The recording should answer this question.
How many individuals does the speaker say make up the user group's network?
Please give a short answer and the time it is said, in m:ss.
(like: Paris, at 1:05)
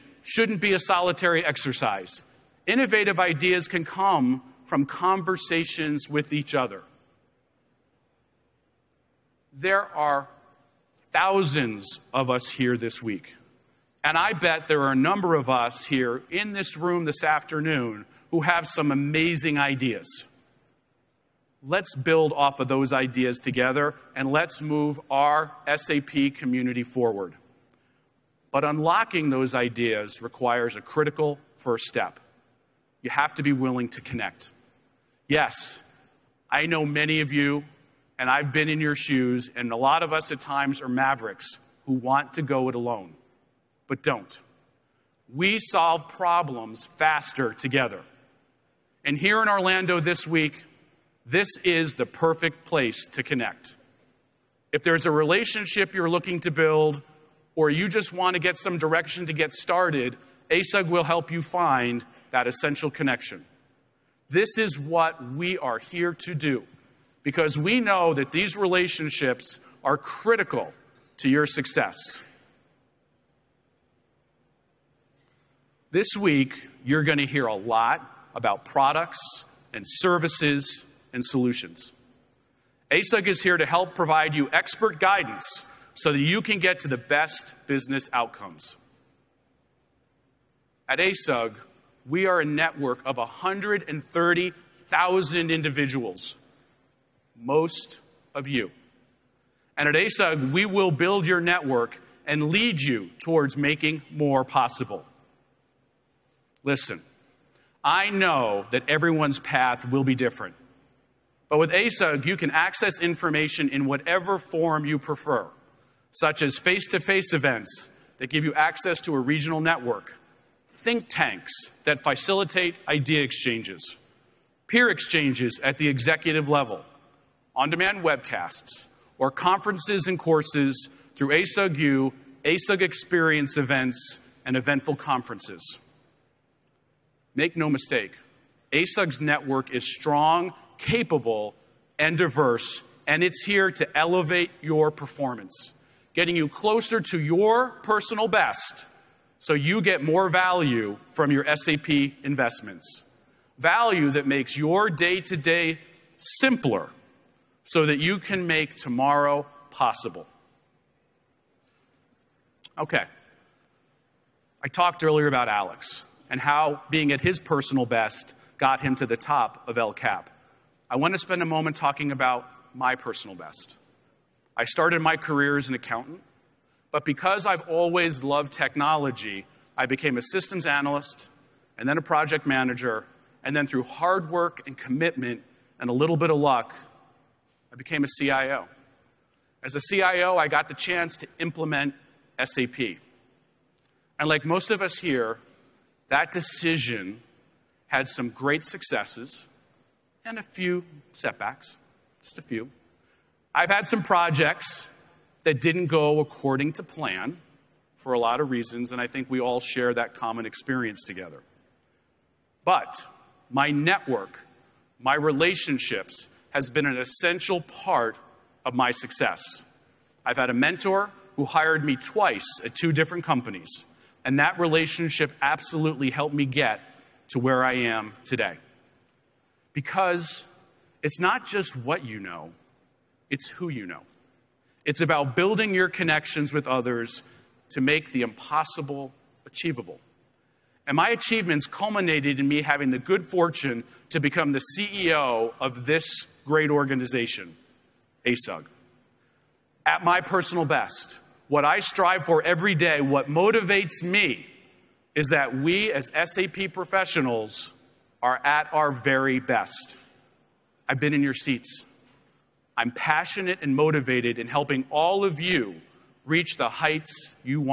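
130,000, at 1:33.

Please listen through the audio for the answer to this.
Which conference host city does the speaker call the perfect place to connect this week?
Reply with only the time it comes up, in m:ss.
0:49.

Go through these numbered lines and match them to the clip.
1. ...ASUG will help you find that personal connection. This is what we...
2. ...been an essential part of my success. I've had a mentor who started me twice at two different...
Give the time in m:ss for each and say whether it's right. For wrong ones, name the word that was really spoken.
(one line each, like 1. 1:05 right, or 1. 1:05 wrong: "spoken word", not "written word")
1. 1:00 wrong: "essential", not "personal"
2. 3:36 wrong: "hired", not "started".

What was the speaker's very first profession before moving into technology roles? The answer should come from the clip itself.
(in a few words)
Accountant.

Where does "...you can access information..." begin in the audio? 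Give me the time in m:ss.
1:52.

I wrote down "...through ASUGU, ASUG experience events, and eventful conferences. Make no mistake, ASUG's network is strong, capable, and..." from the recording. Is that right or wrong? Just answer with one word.
right.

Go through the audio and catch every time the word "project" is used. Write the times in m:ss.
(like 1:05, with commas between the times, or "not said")
3:02, 3:24.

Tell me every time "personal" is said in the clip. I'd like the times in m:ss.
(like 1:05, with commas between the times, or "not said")
2:27, 2:47, 2:52, 4:10.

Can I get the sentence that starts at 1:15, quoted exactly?
This week, you're going to hear a lot about products and services and solutions.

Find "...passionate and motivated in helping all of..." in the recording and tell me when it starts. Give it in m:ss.
4:22.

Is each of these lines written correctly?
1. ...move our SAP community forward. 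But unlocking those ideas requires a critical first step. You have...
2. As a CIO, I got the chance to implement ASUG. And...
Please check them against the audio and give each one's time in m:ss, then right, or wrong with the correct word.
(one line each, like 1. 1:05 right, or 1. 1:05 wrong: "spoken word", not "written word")
1. 0:24 right
2. 3:09 wrong: "SAP", not "ASUG".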